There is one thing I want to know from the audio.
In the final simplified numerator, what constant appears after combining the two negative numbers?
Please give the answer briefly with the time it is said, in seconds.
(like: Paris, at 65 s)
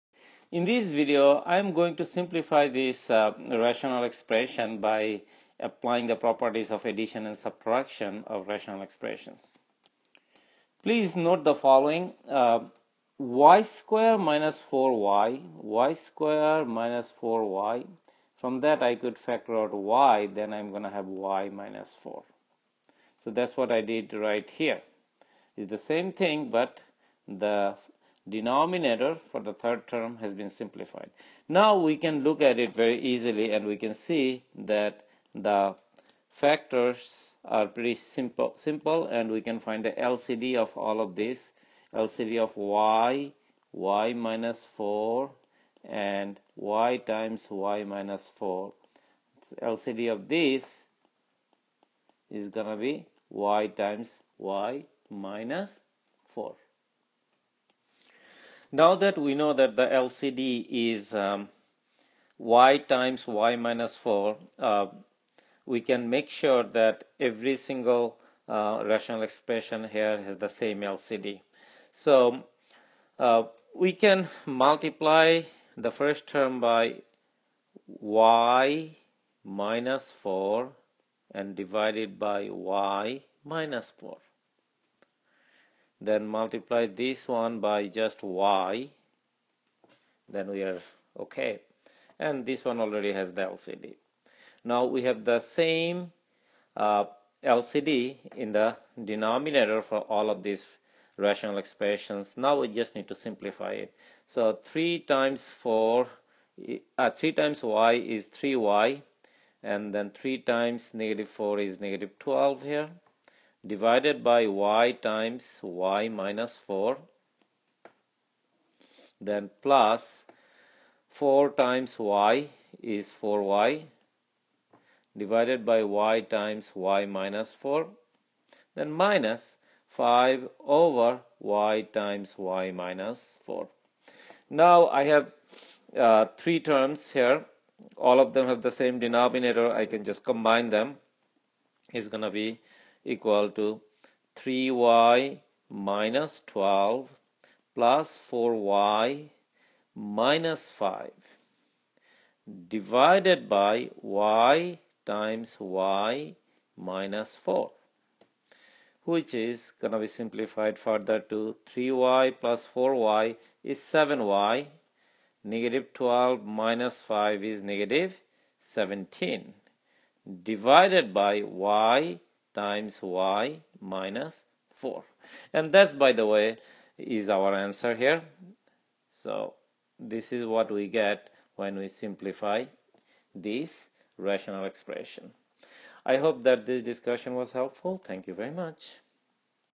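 -17, at 167 s.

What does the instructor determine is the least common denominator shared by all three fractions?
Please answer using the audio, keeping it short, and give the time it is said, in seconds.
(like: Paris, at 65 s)
y(y - 4), at 49 s.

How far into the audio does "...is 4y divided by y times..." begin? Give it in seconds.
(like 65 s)
122 s.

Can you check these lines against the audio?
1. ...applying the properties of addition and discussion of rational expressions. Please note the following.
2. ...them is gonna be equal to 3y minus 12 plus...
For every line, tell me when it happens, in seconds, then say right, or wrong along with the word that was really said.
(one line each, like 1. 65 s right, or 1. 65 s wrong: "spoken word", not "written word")
1. 5 s wrong: "subtraction", not "discussion"
2. 140 s right.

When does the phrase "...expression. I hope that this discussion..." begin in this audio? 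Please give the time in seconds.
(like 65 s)
184 s.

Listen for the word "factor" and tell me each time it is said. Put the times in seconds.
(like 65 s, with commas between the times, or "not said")
19 s, 36 s.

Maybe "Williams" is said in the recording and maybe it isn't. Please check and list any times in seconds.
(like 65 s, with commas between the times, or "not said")
not said.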